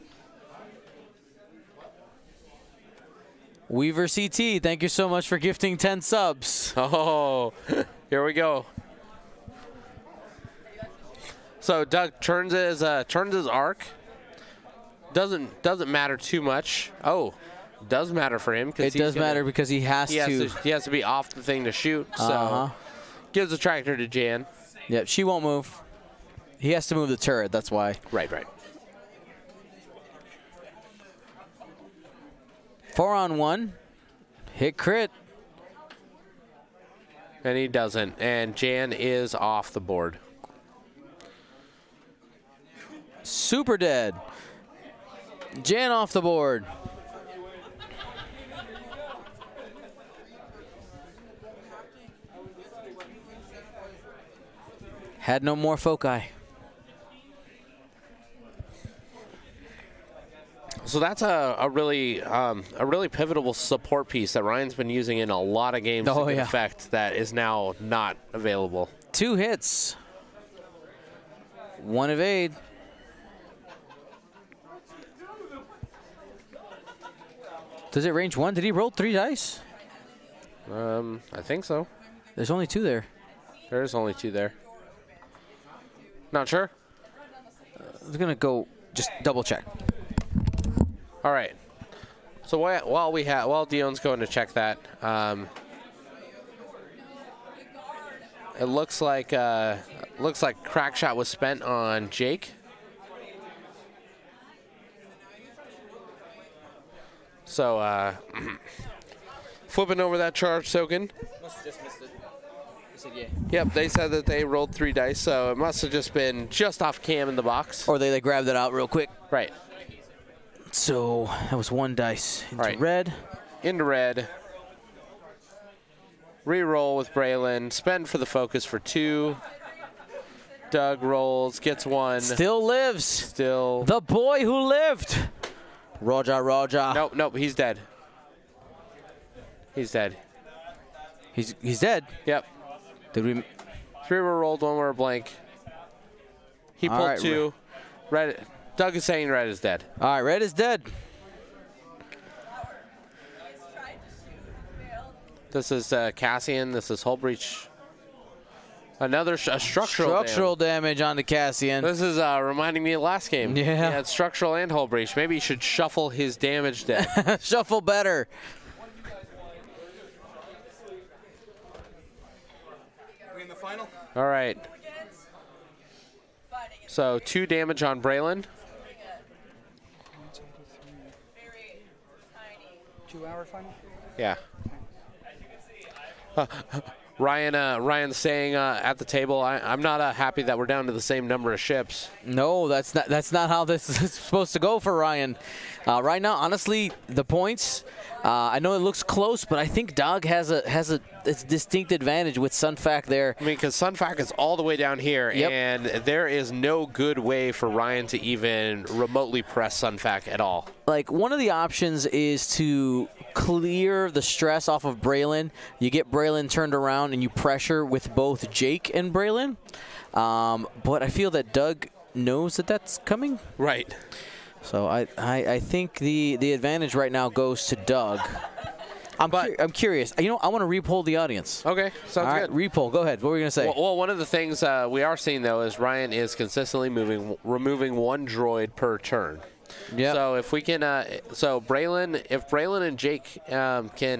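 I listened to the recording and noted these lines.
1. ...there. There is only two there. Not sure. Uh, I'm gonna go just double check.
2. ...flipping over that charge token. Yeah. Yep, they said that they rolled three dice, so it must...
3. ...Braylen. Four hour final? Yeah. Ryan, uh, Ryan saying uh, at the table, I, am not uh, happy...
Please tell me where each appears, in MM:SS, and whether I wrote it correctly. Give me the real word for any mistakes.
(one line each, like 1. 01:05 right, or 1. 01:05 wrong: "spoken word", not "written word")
1. 01:22 right
2. 01:49 right
3. 02:58 wrong: "Two", not "Four".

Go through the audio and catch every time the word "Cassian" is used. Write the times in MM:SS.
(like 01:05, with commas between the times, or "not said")
02:36, 02:41.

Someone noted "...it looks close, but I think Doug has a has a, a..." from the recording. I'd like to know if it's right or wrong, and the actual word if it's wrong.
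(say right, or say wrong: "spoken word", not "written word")
right.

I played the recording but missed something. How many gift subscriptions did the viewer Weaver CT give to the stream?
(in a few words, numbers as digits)
10.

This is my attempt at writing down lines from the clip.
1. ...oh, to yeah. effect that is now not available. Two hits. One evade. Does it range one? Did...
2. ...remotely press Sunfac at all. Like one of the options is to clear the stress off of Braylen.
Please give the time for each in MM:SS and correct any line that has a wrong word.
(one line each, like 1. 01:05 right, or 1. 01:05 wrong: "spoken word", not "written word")
1. 01:06 right
2. 03:28 right.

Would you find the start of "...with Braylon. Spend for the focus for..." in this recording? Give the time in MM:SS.
02:06.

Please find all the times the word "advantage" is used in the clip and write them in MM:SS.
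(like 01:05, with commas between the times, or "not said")
03:21, 03:46.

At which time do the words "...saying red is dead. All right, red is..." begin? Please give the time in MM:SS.
02:29.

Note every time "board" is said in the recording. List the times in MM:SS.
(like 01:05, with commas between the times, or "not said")
00:39, 00:46.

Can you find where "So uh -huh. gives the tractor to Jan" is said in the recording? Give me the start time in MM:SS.
00:22.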